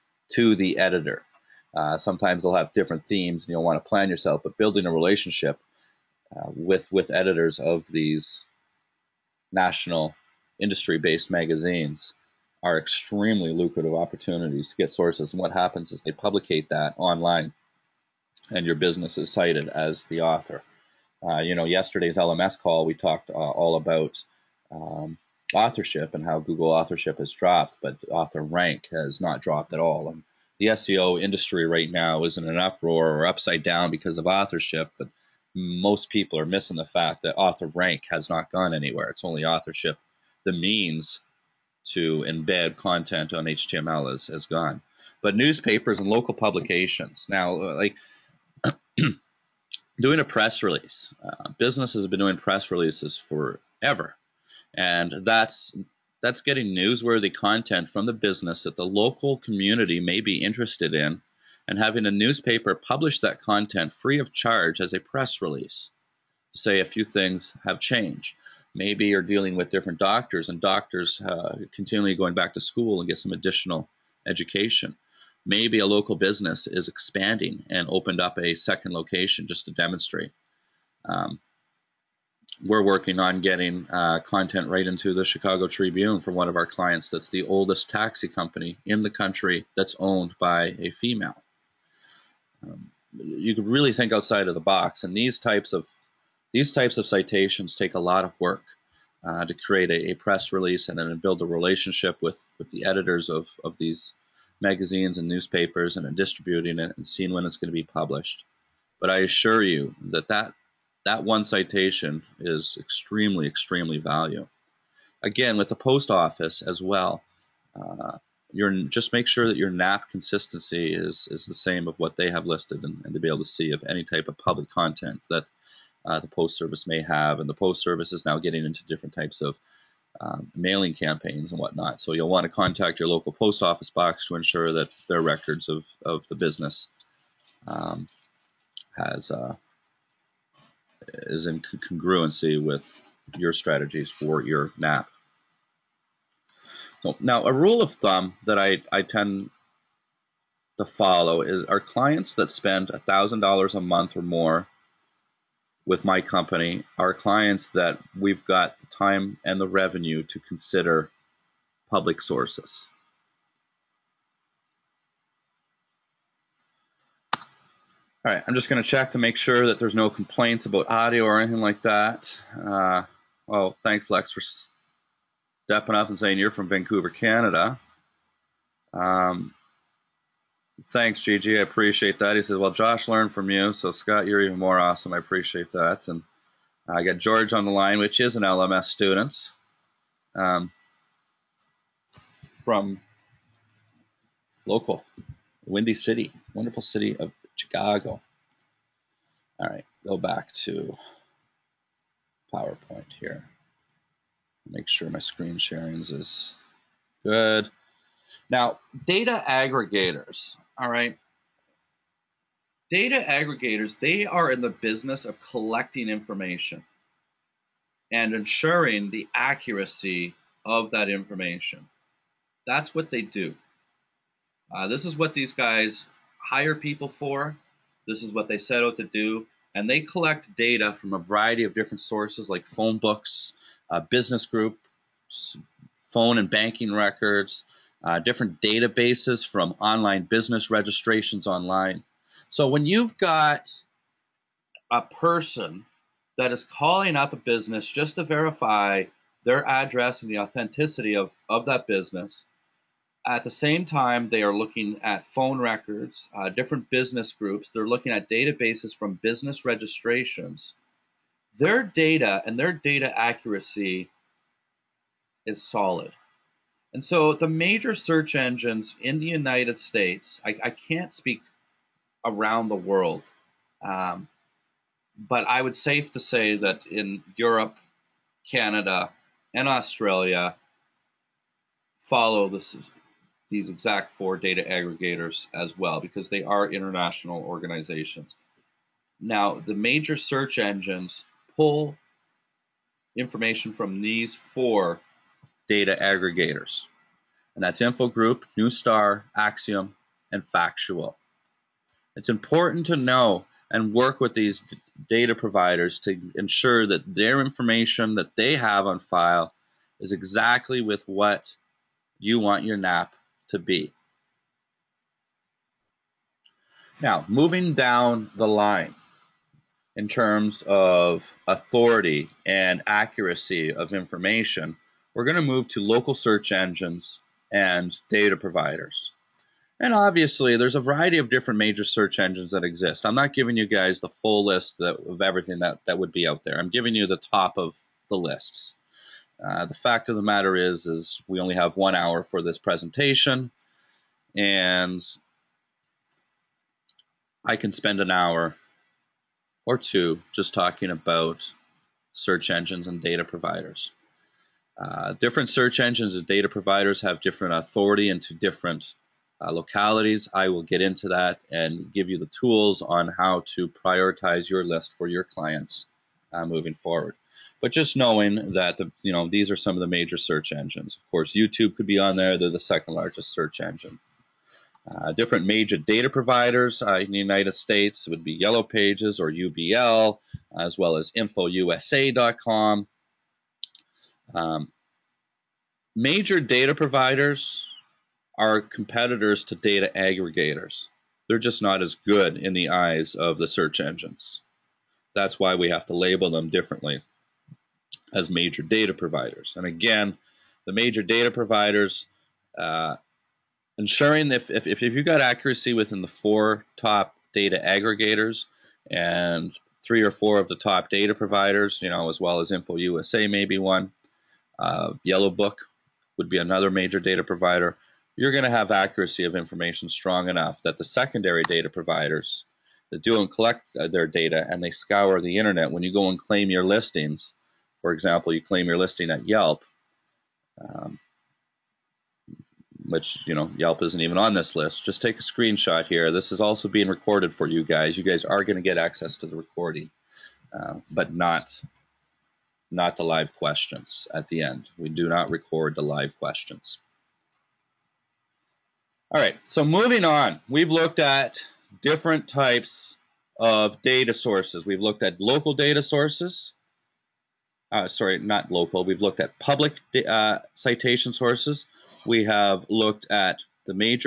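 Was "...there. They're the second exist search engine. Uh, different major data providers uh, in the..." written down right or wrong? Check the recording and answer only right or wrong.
wrong.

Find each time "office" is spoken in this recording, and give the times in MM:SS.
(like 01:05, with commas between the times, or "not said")
01:56, 02:13.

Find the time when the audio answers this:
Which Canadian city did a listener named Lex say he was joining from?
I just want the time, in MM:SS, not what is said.
02:56.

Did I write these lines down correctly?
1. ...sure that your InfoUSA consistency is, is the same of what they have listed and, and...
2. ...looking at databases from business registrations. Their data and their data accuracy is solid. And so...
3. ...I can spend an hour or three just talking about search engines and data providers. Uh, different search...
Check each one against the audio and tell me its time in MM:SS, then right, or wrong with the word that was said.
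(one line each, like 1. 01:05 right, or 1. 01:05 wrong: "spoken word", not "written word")
1. 01:59 wrong: "NAP", not "InfoUSA"
2. 04:17 right
3. 05:47 wrong: "two", not "three".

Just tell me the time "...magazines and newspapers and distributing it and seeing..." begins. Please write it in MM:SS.
01:44.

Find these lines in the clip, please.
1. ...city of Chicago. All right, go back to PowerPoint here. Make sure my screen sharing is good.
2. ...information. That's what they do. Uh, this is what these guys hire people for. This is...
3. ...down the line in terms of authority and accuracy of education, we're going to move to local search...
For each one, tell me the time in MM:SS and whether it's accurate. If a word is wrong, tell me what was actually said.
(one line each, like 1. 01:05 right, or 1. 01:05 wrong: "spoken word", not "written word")
1. 03:16 right
2. 03:41 right
3. 05:17 wrong: "information", not "education".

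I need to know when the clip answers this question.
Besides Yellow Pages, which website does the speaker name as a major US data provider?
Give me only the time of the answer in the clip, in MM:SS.
06:21.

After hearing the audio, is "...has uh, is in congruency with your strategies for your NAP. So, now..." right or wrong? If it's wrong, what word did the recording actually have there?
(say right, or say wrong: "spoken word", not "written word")
right.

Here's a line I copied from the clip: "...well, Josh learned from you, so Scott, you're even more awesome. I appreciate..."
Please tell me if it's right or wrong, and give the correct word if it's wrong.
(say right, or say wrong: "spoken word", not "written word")
right.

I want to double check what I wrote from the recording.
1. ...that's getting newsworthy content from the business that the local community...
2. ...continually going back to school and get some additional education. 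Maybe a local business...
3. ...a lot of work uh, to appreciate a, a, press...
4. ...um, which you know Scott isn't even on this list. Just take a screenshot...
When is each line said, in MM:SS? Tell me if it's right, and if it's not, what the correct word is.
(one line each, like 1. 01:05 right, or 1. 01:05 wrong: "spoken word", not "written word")
1. 00:56 right
2. 01:11 right
3. 01:37 wrong: "create", not "appreciate"
4. 07:10 wrong: "Yelp", not "Scott".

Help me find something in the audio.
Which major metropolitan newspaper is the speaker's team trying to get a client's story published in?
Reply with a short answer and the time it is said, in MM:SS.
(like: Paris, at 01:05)
Chicago Tribune, at 01:25.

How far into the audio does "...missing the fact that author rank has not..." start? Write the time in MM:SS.
00:36.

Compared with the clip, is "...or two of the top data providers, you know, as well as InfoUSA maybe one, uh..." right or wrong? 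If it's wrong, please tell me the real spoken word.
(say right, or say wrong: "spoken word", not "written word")
wrong: "four", not "two".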